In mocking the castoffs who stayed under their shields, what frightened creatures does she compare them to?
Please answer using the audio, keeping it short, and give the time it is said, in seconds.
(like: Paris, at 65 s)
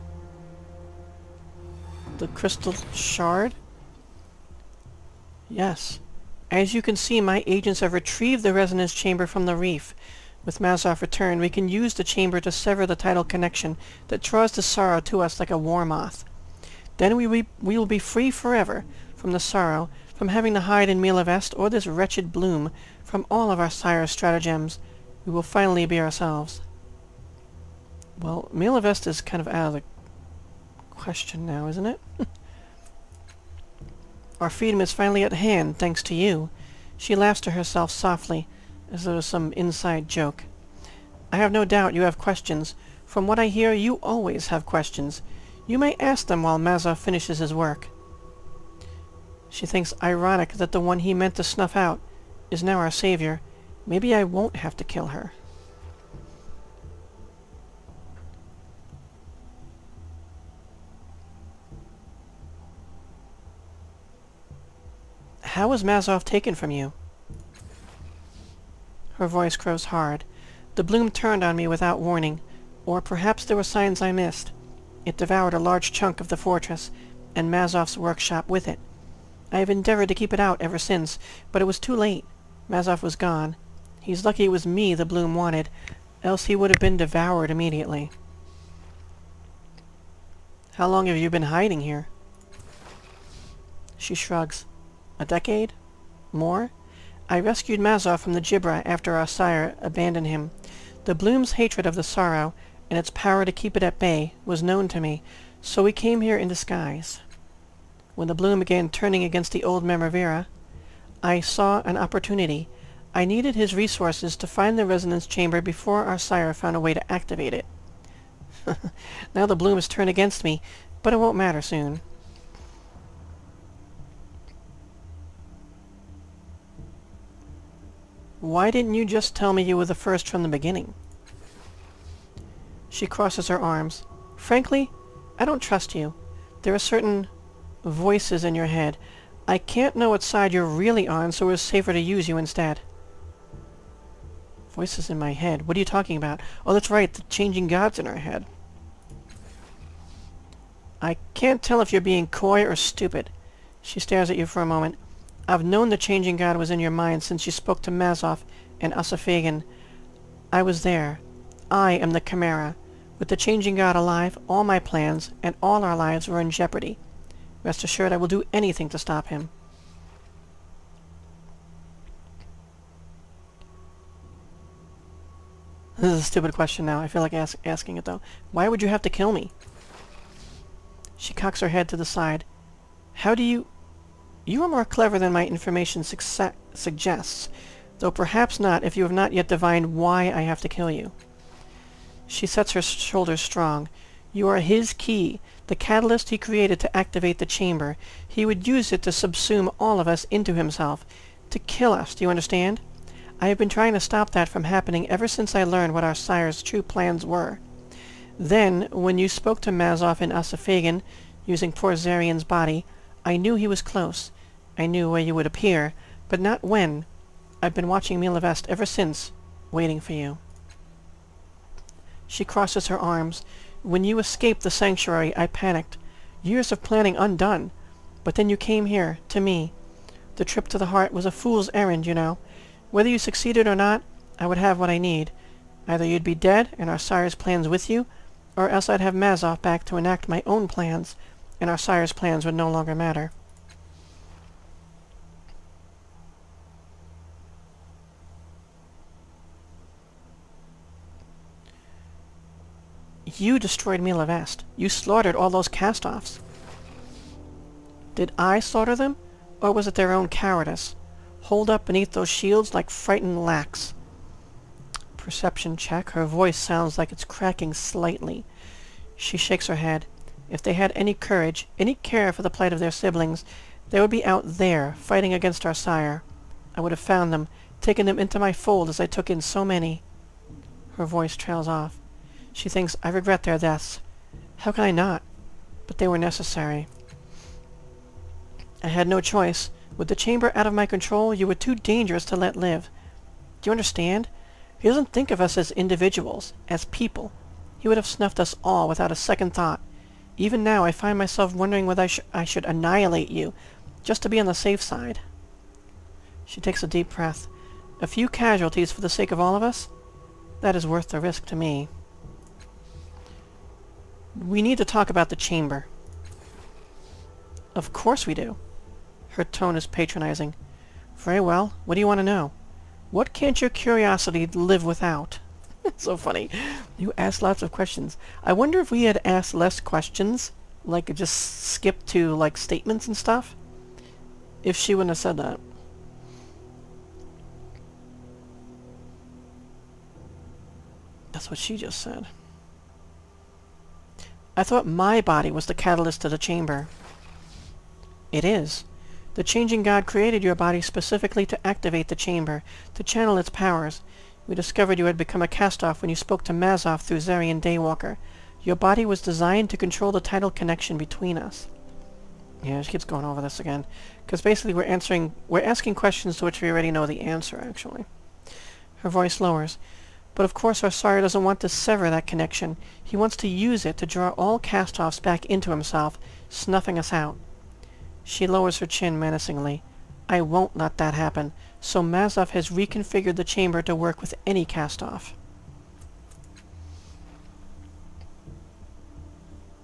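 lacks, at 263 s.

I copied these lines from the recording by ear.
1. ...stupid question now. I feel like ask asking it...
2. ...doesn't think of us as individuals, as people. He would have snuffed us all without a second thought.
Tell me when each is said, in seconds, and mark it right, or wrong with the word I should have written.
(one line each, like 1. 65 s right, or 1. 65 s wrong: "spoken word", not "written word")
1. 176 s right
2. 294 s right.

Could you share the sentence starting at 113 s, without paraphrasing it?
I needed his resources to find the resonance chamber before our sire found a way to activate it.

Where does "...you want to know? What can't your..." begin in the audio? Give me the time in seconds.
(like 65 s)
321 s.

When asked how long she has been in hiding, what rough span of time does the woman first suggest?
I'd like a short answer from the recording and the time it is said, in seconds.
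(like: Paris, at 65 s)
A decade, at 95 s.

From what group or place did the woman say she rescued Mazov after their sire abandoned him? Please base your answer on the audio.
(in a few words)
the Gibra.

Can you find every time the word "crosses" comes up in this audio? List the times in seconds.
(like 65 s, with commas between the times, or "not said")
133 s, 222 s.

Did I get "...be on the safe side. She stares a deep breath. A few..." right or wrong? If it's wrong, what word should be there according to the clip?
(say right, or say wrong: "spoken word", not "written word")
wrong: "takes", not "stares".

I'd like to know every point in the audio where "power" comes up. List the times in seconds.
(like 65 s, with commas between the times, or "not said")
103 s, 353 s.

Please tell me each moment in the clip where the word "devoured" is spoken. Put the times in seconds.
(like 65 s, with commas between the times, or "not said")
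75 s, 86 s.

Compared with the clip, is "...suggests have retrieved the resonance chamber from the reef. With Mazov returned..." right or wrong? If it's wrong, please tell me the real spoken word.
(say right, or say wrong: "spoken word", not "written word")
wrong: "agents", not "suggests".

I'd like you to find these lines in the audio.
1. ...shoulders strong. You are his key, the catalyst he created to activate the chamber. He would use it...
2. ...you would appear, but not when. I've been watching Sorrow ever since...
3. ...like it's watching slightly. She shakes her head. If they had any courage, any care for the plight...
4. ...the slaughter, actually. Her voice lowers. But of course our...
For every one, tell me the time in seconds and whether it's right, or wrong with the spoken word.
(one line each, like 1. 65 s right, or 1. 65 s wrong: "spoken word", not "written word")
1. 192 s right
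2. 215 s wrong: "Milavest", not "Sorrow"
3. 266 s wrong: "cracking", not "watching"
4. 367 s wrong: "answer", not "slaughter".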